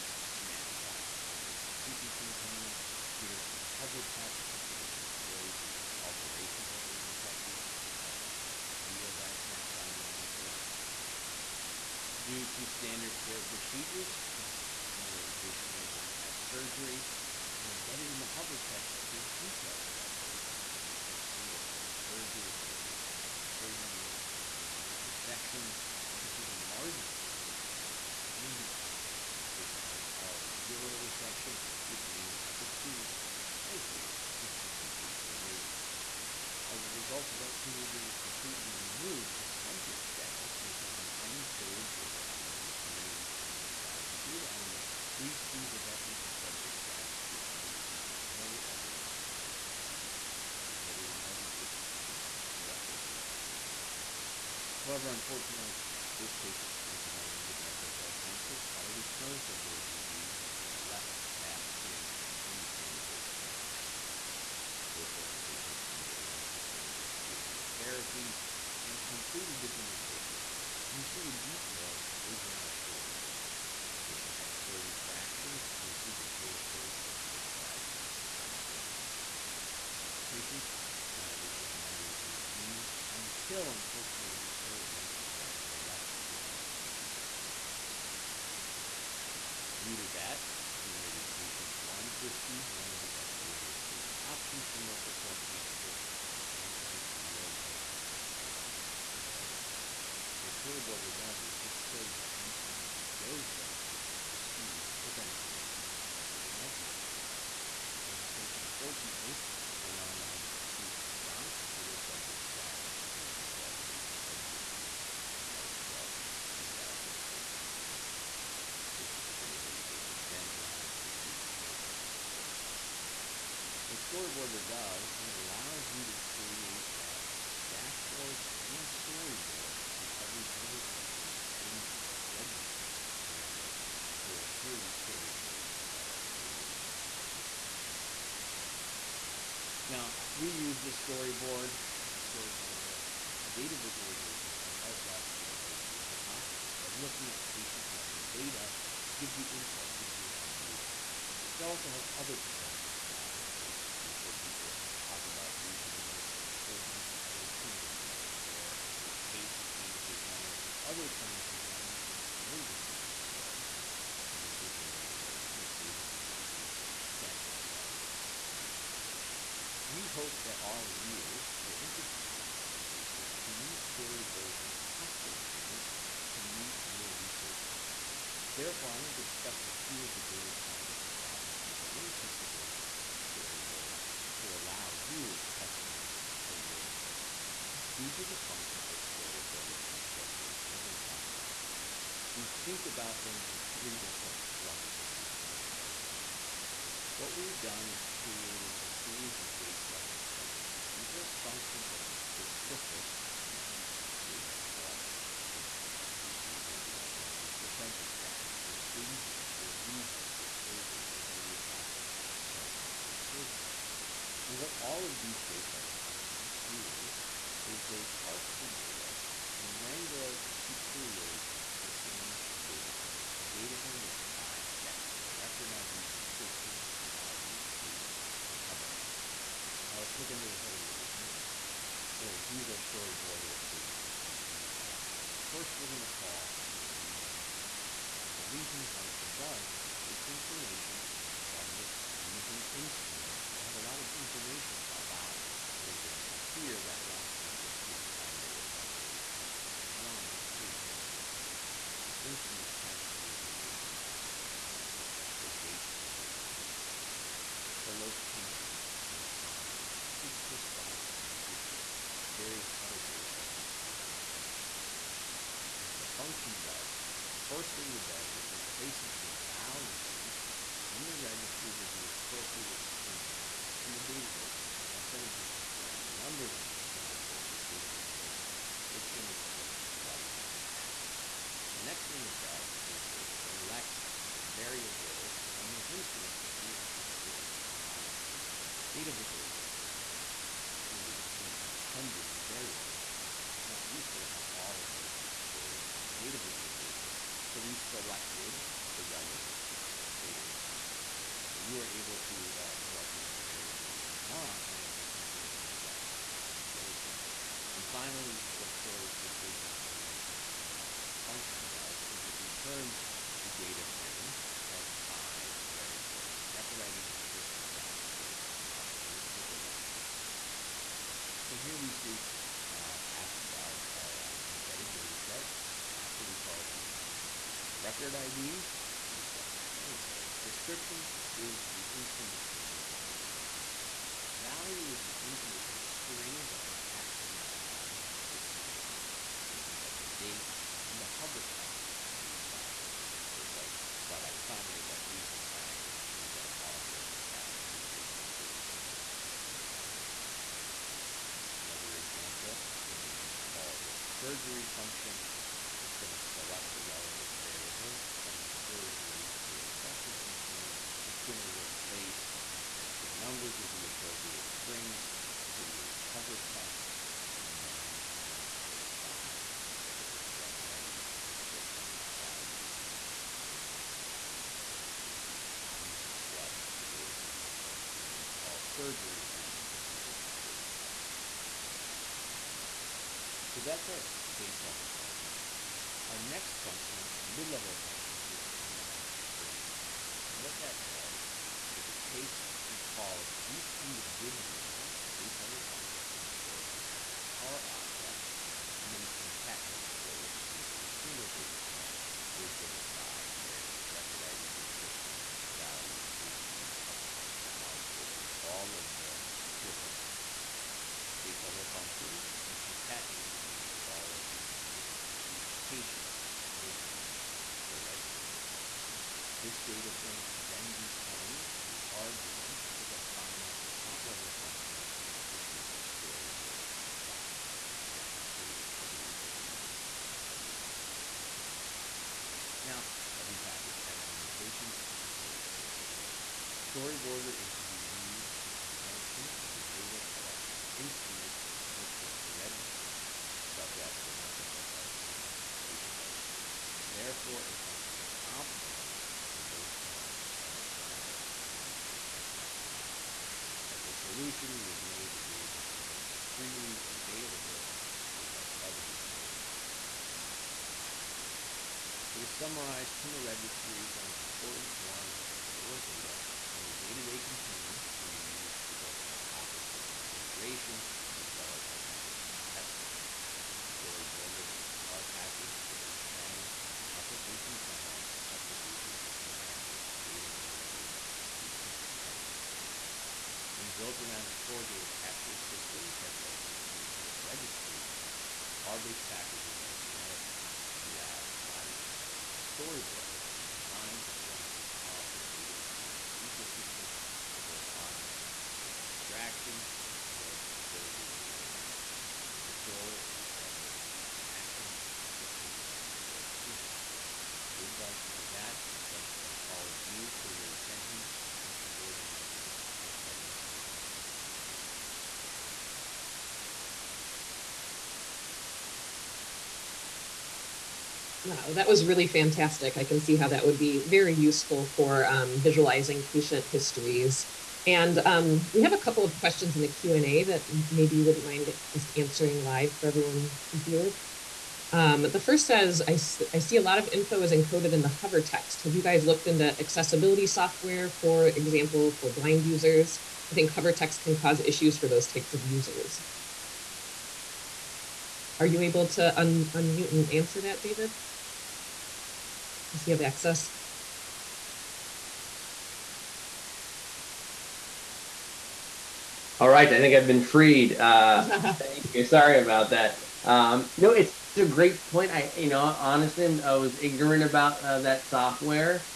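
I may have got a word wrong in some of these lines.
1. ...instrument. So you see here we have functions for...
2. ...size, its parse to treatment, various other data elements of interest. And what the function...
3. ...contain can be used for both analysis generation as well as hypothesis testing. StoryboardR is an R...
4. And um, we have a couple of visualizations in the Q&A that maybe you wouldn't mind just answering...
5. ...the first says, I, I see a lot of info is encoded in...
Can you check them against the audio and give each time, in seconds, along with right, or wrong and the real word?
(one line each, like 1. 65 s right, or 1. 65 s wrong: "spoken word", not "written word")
1. 205 s right
2. 259 s wrong: "response", not "parse"
3. 467 s wrong: "hypothesis", not "analysis"
4. 527 s wrong: "questions", not "visualizations"
5. 535 s right.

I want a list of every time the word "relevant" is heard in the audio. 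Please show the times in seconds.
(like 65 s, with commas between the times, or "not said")
280 s, 299 s, 356 s.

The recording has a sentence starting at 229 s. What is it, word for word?
Now let's look under the hood a little bit more.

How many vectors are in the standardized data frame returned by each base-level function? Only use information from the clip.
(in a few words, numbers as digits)
5.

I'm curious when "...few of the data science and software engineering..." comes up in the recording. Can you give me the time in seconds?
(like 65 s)
179 s.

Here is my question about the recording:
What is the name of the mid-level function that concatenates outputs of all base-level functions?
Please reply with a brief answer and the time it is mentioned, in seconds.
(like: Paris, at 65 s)
combine storyboarder, at 388 s.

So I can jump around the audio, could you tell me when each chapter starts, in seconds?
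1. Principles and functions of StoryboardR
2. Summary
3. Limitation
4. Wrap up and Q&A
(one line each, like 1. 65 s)
1. 146 s
2. 467 s
3. 437 s
4. 526 s.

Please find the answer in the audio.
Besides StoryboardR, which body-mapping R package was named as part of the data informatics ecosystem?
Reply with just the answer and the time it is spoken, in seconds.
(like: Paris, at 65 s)
BodyMapR, at 491 s.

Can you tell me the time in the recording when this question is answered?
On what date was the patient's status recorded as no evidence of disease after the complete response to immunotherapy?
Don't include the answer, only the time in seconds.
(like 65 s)
115 s.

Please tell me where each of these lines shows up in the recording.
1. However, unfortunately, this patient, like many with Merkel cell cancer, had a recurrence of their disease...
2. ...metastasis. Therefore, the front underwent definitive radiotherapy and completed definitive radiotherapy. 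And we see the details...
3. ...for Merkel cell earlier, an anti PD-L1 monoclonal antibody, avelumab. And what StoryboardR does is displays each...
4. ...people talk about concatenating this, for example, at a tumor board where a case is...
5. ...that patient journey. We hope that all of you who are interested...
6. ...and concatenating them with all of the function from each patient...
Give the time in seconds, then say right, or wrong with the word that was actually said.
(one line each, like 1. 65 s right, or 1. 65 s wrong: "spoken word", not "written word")
1. 54 s right
2. 63 s wrong: "patient", not "front"
3. 94 s wrong: "cancer", not "earlier"
4. 154 s wrong: "using", not "concatenating"
5. 167 s right
6. 412 s wrong: "information", not "function".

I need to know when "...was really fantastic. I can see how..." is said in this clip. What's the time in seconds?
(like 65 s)
521 s.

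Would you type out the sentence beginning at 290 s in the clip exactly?
Some of these instruments have hundreds of variables.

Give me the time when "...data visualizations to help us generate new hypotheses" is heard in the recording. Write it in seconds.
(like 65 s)
143 s.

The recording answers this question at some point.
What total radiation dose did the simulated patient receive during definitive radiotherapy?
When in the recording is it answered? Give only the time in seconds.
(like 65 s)
77 s.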